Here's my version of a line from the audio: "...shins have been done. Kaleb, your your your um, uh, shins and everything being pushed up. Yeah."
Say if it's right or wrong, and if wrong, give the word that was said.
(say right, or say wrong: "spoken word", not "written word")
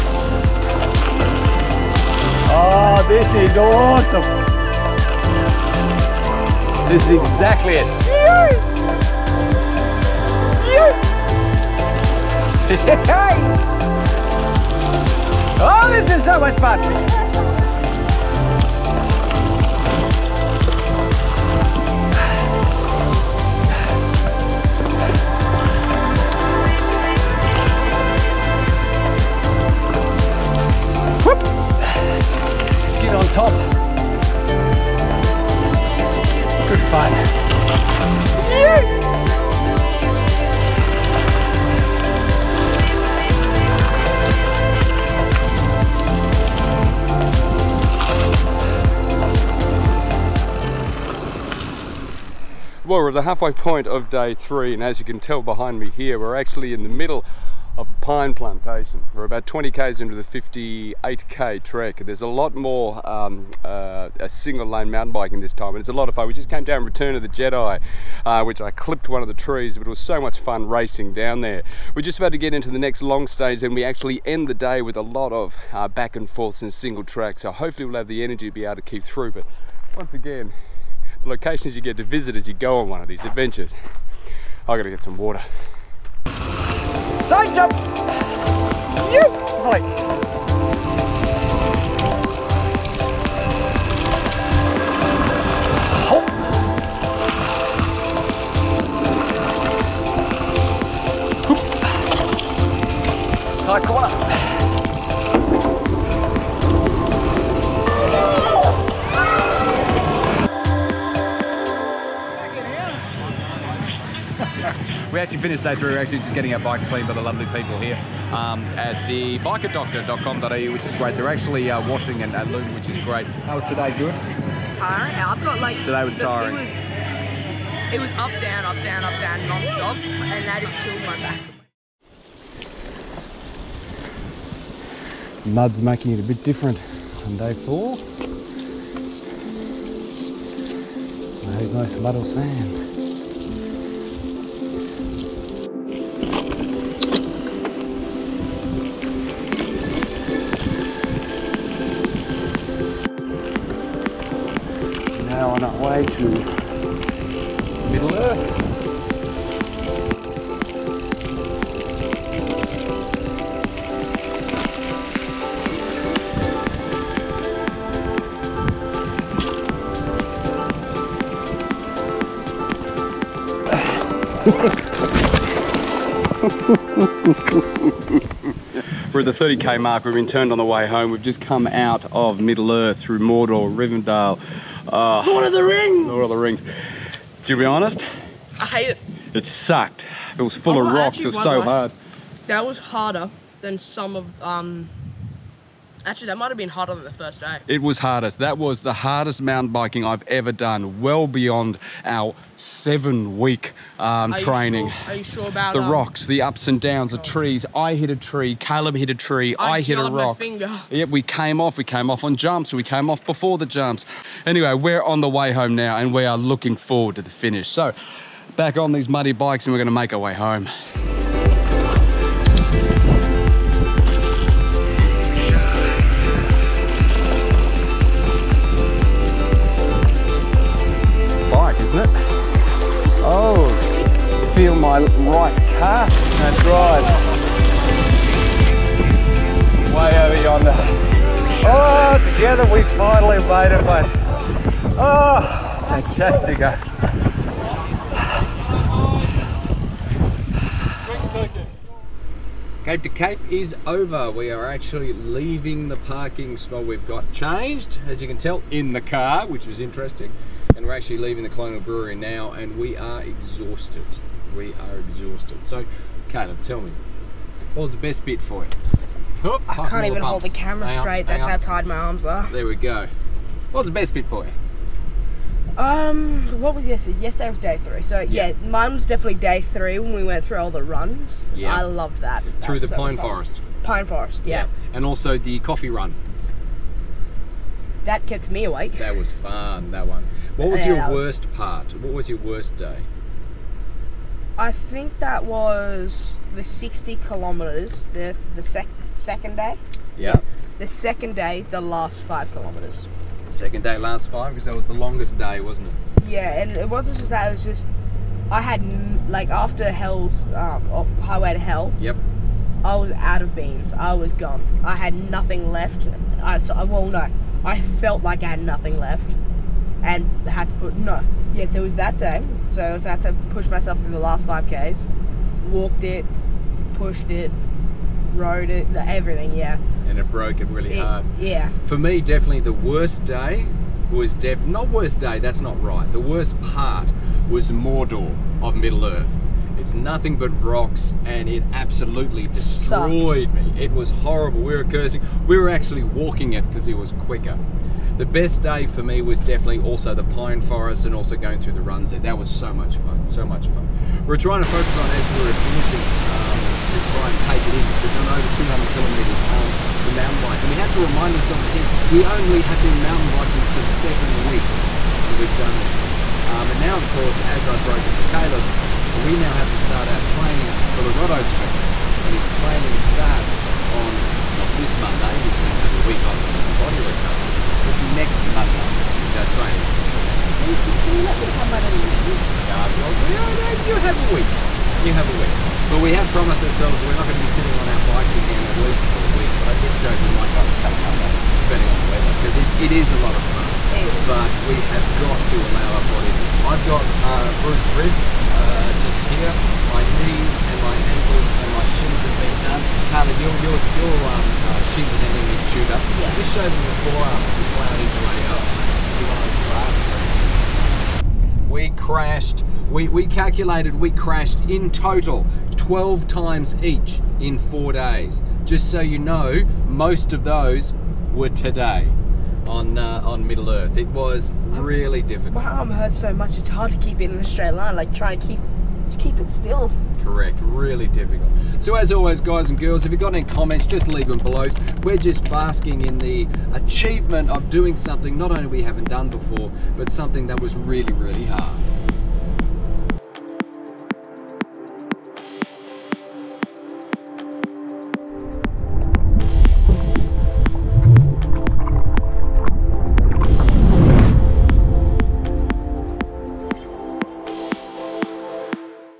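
wrong: "chewed", not "pushed".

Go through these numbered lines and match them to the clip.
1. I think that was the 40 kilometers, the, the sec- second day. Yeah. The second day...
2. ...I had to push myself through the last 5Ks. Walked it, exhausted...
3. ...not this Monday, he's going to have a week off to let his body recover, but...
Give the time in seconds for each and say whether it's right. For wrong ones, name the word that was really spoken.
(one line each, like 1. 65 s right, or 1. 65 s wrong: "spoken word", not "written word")
1. 294 s wrong: "60", not "40"
2. 322 s wrong: "pushed", not "exhausted"
3. 374 s right.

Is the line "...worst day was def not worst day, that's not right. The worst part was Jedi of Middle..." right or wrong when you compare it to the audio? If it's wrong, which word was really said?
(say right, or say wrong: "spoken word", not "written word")
wrong: "Mordor", not "Jedi".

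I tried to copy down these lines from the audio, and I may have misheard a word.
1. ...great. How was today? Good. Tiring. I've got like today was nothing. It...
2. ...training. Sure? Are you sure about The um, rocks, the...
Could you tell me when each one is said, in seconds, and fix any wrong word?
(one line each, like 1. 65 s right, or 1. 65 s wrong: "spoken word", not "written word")
1. 123 s wrong: "tiring", not "nothing"
2. 204 s right.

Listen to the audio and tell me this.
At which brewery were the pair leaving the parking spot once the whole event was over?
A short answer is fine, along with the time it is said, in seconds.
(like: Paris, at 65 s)
Colonial Brewery, at 261 s.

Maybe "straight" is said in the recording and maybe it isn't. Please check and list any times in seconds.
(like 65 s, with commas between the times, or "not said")
271 s, 427 s.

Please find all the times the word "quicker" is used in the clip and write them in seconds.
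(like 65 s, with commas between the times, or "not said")
347 s.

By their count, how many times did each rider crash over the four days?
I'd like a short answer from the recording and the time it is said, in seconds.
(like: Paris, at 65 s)
12, at 415 s.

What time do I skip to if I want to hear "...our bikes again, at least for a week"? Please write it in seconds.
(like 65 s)
387 s.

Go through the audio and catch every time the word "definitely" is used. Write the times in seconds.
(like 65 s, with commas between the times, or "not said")
279 s, 332 s, 349 s.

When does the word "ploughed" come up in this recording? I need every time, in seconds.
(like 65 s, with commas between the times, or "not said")
407 s.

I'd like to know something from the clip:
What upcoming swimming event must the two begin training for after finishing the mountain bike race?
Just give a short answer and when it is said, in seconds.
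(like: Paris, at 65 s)
Rotto swim, at 371 s.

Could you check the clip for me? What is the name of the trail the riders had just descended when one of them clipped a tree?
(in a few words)
Return of the Jedi.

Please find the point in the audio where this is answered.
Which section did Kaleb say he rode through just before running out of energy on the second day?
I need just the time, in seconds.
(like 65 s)
311 s.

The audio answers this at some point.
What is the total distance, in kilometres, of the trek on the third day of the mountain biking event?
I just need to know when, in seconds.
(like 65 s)
60 s.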